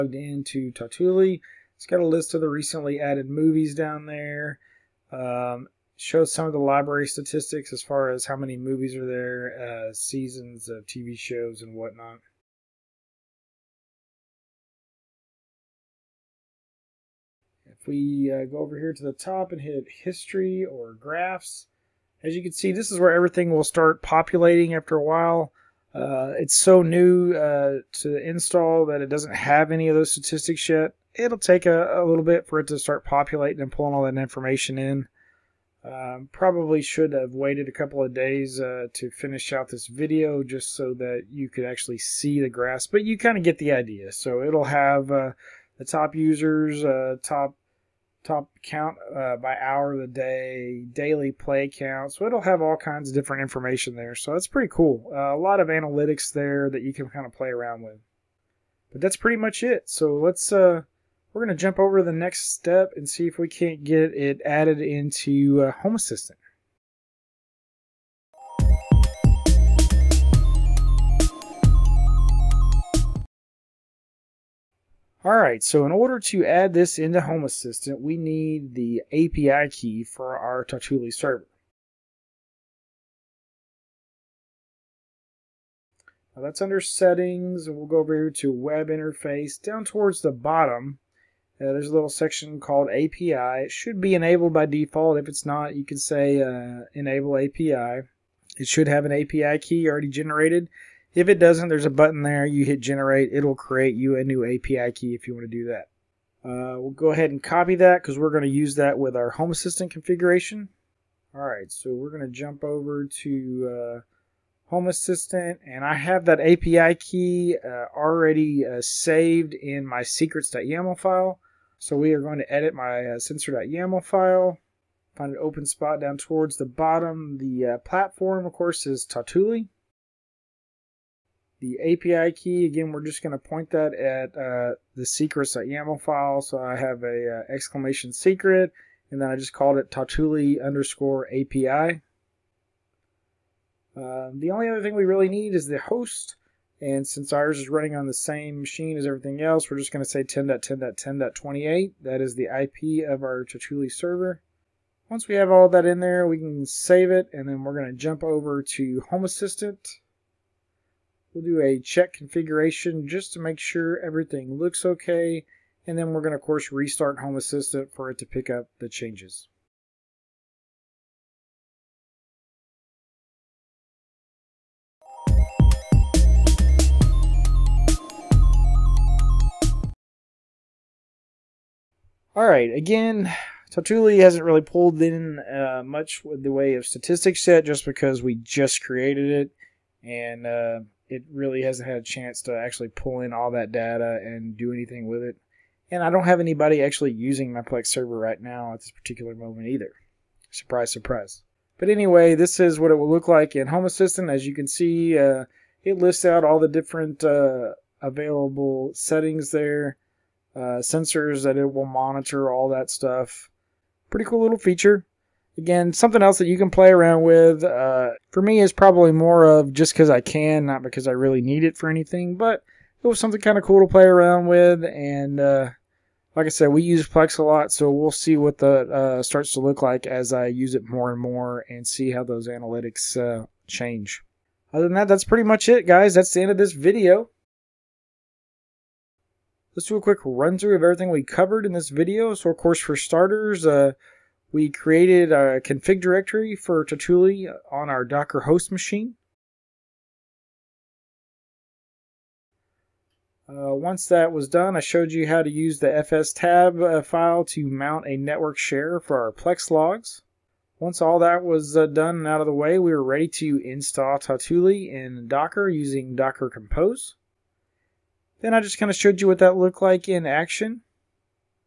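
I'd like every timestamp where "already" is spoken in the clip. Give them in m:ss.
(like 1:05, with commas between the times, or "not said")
1:39, 1:57.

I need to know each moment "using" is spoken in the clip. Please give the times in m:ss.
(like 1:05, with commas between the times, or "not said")
3:17, 4:25.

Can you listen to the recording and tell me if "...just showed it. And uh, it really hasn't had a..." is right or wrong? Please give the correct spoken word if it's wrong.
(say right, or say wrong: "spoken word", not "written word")
wrong: "created", not "showed".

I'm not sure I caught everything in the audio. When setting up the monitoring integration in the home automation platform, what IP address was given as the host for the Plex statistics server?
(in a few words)
10.10.10.28.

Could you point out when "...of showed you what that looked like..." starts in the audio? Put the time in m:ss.
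4:28.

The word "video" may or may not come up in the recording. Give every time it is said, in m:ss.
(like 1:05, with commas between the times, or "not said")
0:39, 3:56, 4:01.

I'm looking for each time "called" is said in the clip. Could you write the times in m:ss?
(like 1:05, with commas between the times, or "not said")
1:32, 2:19.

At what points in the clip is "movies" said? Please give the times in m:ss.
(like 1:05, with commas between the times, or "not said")
0:03, 0:08.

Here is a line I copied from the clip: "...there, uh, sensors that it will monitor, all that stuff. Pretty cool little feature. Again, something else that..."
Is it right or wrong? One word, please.
right.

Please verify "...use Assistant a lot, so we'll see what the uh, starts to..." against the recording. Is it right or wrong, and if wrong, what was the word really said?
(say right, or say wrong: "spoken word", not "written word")
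wrong: "Plex", not "Assistant".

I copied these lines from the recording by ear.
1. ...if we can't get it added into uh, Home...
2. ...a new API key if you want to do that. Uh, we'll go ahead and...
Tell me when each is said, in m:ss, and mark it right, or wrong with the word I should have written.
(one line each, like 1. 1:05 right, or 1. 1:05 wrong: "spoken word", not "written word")
1. 1:03 right
2. 1:44 right.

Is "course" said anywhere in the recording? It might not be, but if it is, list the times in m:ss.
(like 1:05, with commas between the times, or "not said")
2:08, 2:46, 4:02.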